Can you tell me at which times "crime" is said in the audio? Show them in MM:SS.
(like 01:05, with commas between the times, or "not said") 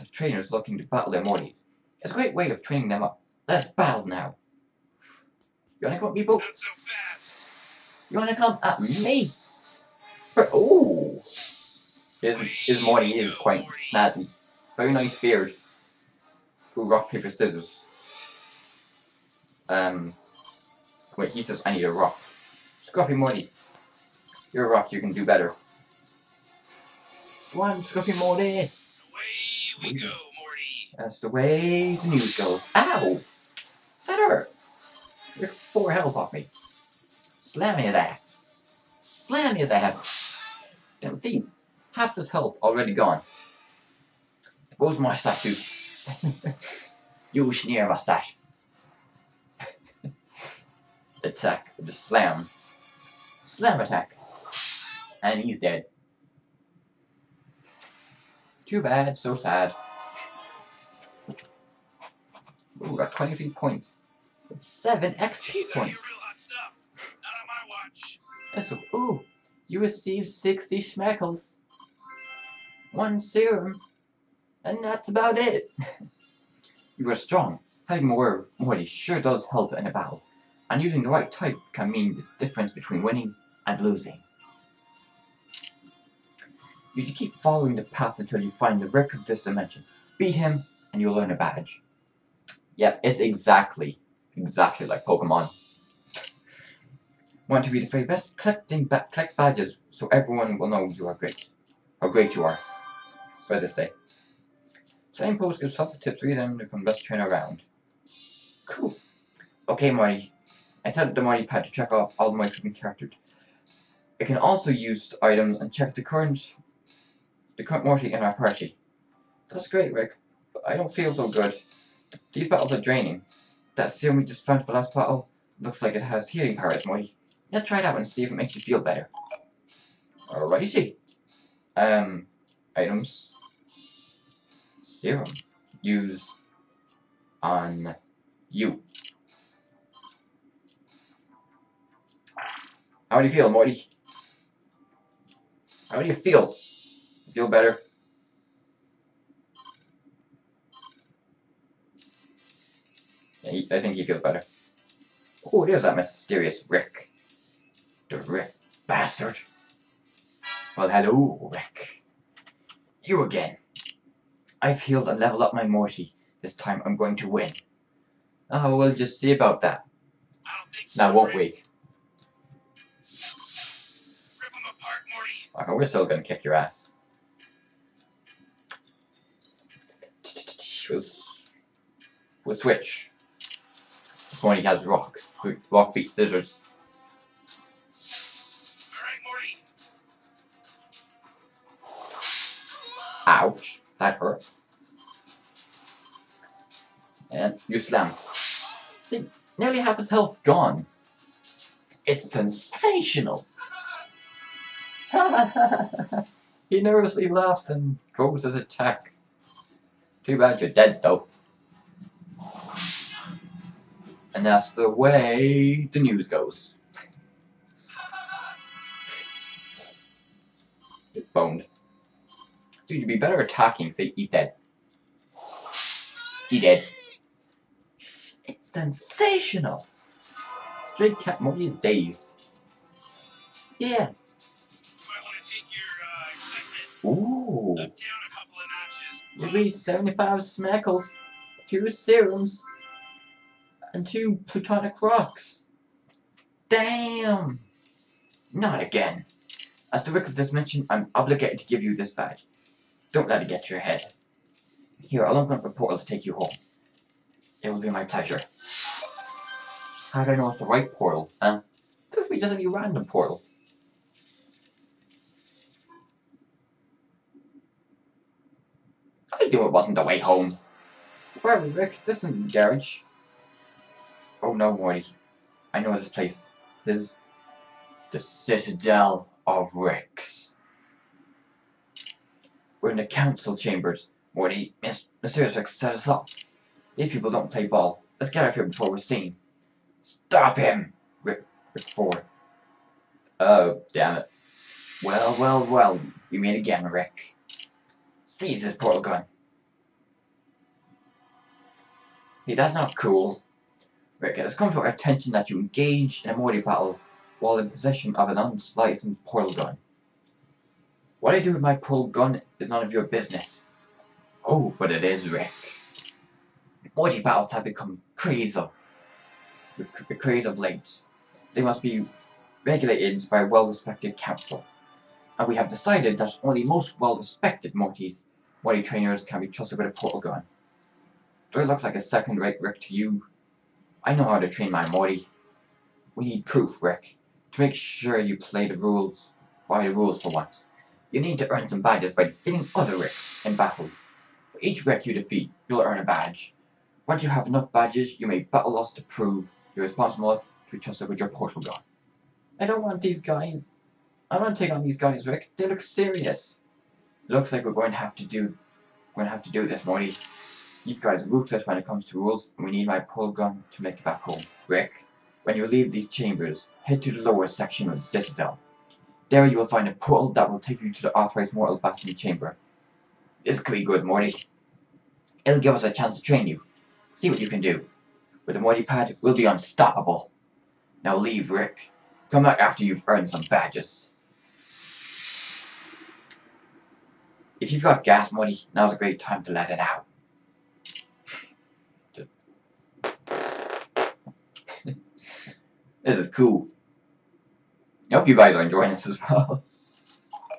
not said.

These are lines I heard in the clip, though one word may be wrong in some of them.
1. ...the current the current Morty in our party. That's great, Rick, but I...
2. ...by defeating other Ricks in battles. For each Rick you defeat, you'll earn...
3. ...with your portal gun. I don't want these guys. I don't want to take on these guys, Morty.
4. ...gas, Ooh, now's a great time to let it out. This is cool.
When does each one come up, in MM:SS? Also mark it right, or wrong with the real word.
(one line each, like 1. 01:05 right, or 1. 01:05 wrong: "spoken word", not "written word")
1. 01:55 right
2. 05:42 right
3. 05:51 wrong: "Rick", not "Morty"
4. 06:28 wrong: "Morty", not "Ooh".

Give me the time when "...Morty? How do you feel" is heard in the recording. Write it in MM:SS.
02:23.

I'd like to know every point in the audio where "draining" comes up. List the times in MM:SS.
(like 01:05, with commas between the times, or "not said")
02:02.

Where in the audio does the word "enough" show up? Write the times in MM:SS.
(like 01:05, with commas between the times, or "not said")
05:47.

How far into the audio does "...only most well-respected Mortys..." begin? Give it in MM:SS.
05:26.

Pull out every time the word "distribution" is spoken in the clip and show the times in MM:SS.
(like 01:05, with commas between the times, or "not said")
not said.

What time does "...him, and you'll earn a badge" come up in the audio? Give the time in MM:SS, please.
01:30.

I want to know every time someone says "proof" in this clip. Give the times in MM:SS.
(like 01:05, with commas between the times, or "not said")
05:36.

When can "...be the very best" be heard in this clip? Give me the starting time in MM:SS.
01:37.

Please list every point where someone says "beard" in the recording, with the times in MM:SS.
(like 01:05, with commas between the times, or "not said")
00:15.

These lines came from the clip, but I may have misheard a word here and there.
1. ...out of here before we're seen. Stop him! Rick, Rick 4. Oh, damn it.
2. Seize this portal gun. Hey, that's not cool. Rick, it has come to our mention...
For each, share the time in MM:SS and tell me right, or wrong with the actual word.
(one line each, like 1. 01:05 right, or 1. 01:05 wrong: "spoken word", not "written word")
1. 04:48 right
2. 04:58 wrong: "attention", not "mention".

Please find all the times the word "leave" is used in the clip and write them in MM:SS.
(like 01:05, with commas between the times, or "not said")
06:05, 06:21.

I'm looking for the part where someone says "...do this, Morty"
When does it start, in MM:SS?
05:59.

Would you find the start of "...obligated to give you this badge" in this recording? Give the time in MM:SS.
04:11.